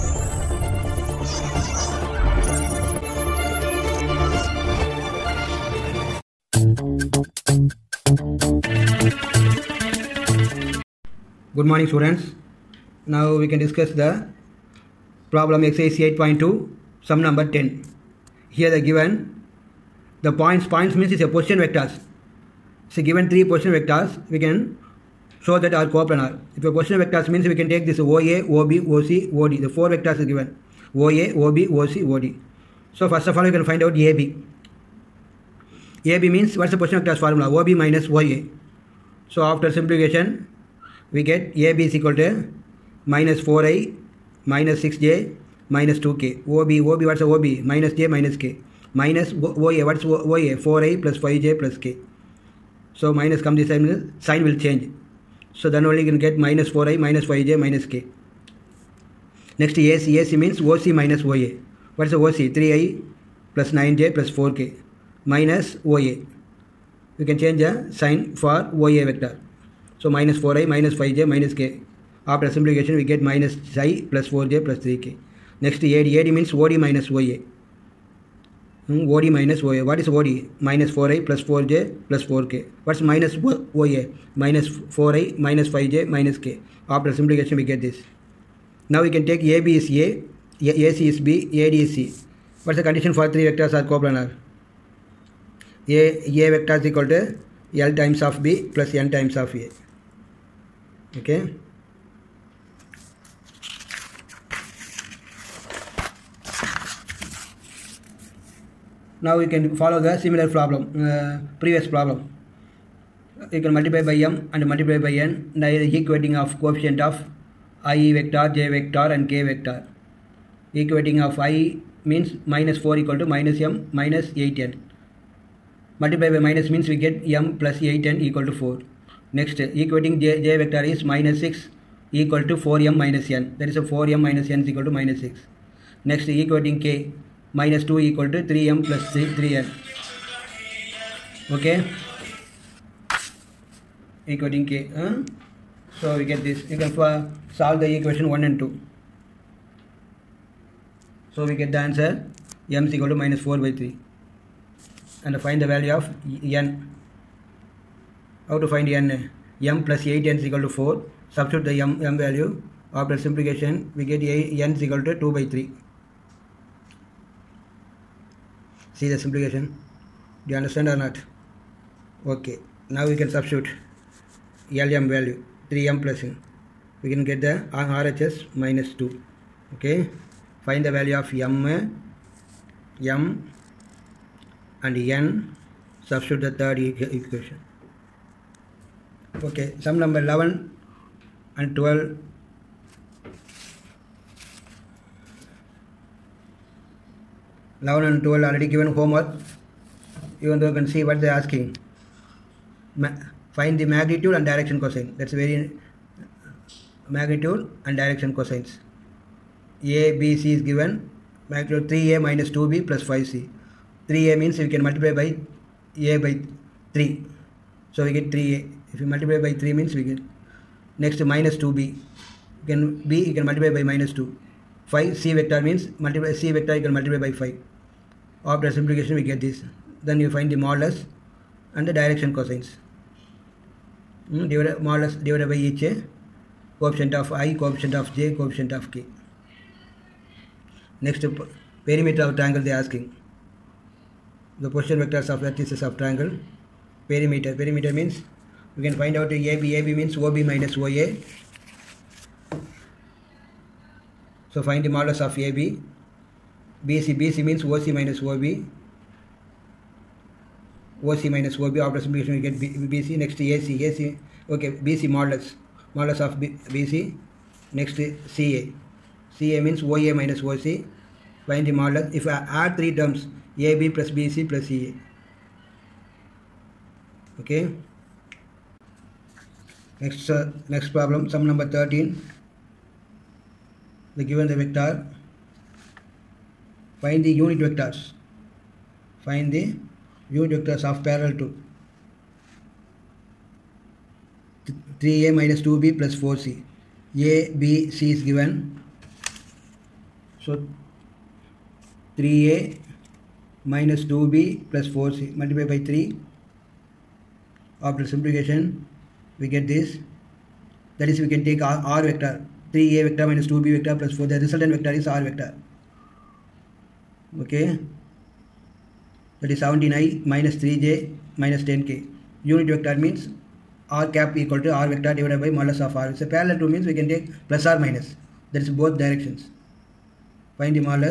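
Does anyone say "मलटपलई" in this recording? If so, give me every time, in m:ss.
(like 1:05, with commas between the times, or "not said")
5:05.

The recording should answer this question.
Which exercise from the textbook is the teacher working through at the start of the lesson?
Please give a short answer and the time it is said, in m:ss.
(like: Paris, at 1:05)
8.2, at 0:15.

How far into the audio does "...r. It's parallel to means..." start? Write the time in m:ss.
5:25.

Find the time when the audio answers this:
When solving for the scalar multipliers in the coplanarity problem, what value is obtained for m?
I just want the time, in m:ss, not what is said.
2:33.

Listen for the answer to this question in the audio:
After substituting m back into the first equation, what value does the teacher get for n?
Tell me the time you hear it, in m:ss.
2:45.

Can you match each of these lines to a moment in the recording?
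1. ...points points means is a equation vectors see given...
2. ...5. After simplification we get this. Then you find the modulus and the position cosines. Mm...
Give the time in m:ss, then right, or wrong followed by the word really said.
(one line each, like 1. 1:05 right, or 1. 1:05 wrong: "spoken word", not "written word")
1. 0:20 wrong: "position", not "equation"
2. 3:47 wrong: "direction", not "position".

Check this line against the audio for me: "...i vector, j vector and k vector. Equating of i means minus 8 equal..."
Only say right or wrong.
wrong.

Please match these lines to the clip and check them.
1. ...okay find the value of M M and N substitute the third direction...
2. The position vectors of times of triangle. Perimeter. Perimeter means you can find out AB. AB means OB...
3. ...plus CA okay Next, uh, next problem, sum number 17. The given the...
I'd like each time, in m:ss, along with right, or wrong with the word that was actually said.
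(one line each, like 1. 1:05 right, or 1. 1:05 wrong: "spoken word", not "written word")
1. 2:59 wrong: "equation", not "direction"
2. 4:04 wrong: "vertices", not "times"
3. 4:34 wrong: "13", not "17".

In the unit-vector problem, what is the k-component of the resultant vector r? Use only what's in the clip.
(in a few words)
-10.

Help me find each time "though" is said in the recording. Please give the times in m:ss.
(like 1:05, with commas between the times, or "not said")
3:20.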